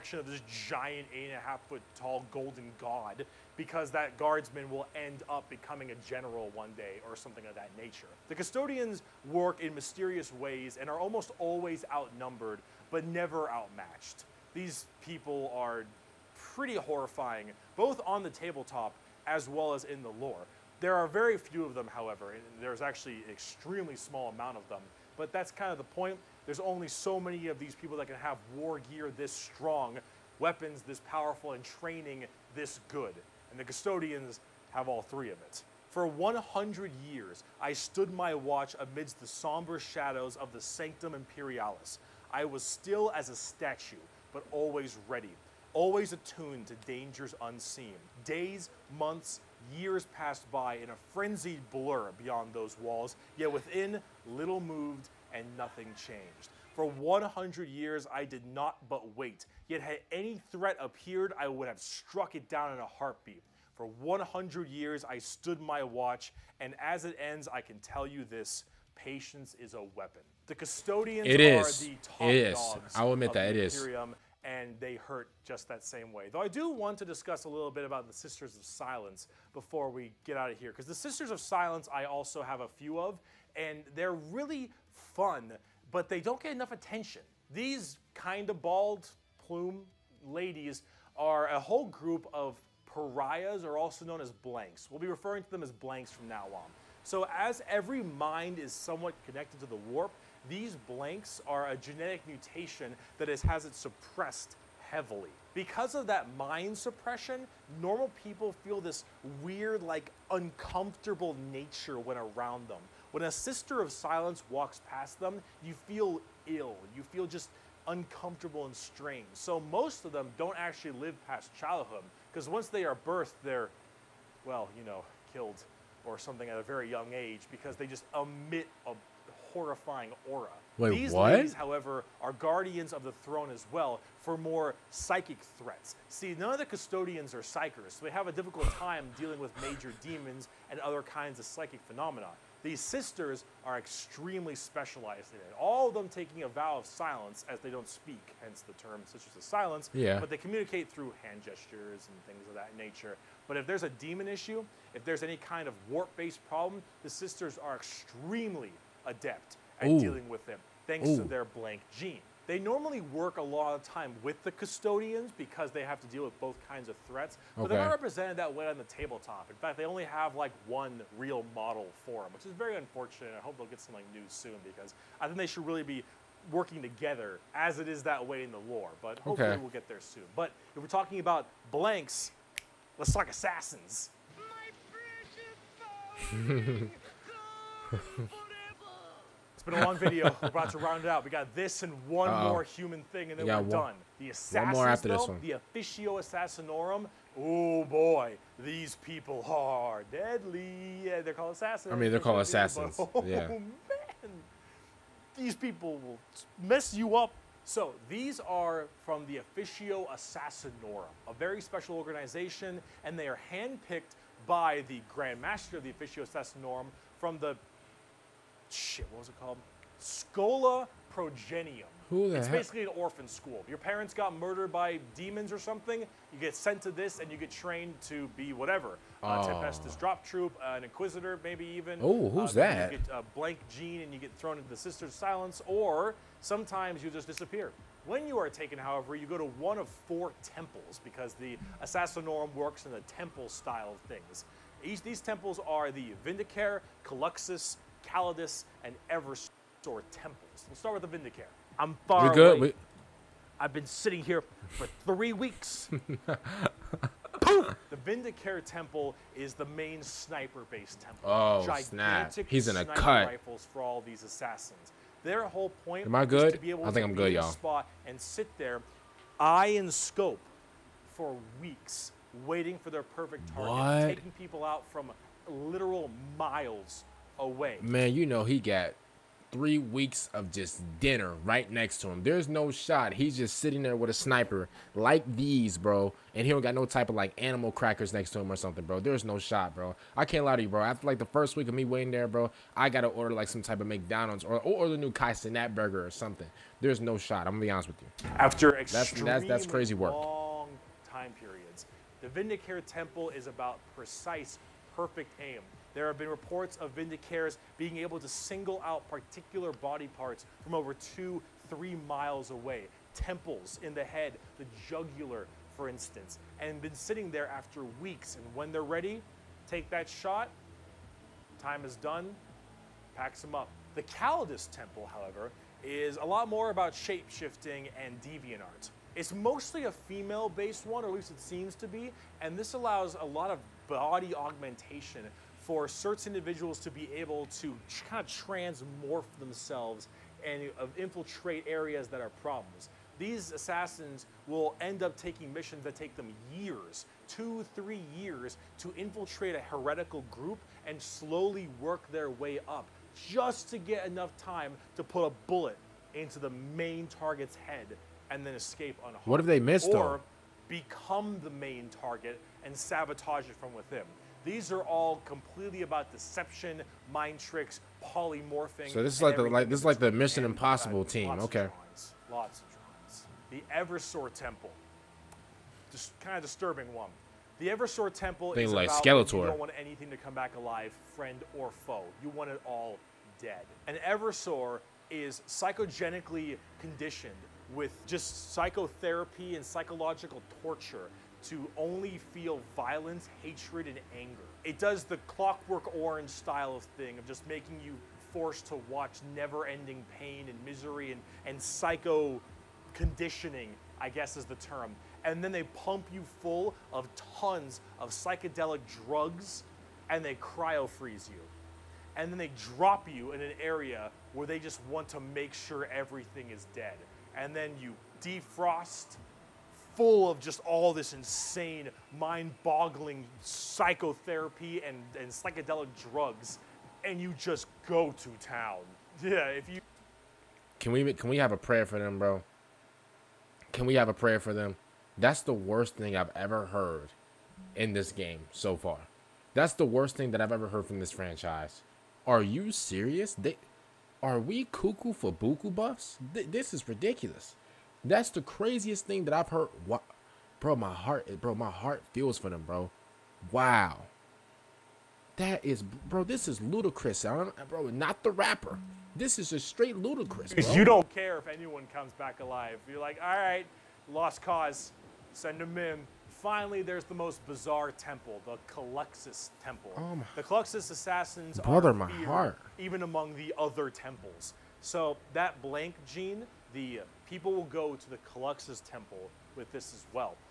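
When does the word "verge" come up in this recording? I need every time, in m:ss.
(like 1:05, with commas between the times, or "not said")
not said.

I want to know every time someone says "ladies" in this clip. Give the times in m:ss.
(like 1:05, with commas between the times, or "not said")
1:30, 2:11.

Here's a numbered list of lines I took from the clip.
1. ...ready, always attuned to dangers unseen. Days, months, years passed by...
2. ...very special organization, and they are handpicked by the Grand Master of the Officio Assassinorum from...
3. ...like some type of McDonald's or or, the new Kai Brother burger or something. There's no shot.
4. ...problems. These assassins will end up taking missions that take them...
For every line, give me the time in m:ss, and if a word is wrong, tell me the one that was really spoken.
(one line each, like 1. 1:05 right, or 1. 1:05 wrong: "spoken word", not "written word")
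1. 0:45 right
2. 3:31 right
3. 4:53 wrong: "Cenat", not "Brother"
4. 5:42 right.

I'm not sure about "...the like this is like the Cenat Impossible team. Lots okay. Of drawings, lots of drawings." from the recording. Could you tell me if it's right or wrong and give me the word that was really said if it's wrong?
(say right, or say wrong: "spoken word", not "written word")
wrong: "Mission", not "Cenat".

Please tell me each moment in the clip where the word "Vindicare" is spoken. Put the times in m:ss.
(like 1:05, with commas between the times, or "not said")
4:06, 4:11, 4:18, 5:02, 5:06.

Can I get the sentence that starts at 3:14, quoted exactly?
The assassins, one more after though, this one.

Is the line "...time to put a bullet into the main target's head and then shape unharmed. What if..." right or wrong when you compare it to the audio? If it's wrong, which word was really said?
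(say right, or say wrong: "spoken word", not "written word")
wrong: "escape", not "shape".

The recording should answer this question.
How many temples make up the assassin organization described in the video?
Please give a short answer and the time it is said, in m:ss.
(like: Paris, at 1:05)
4, at 4:00.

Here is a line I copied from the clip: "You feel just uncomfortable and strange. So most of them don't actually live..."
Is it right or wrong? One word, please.
right.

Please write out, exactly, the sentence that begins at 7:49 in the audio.
Oh the Culexus assassins Brother, my feared, heart.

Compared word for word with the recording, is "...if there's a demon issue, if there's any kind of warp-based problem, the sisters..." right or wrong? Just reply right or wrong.
right.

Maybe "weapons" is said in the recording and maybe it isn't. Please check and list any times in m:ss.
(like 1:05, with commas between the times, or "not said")
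0:30, 1:09.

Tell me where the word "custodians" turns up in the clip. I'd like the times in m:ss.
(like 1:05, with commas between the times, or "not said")
0:08, 0:33, 1:10, 2:16, 2:44.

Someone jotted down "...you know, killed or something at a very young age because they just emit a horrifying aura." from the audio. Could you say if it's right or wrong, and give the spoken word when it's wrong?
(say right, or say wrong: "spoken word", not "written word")
right.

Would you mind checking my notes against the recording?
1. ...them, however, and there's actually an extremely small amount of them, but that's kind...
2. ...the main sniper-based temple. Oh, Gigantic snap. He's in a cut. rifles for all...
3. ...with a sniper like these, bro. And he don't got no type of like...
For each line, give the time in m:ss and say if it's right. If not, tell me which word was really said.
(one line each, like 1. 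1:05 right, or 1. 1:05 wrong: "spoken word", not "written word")
1. 0:21 right
2. 4:19 right
3. 4:43 right.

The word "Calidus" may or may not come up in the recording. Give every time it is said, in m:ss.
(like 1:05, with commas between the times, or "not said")
4:08, 5:24.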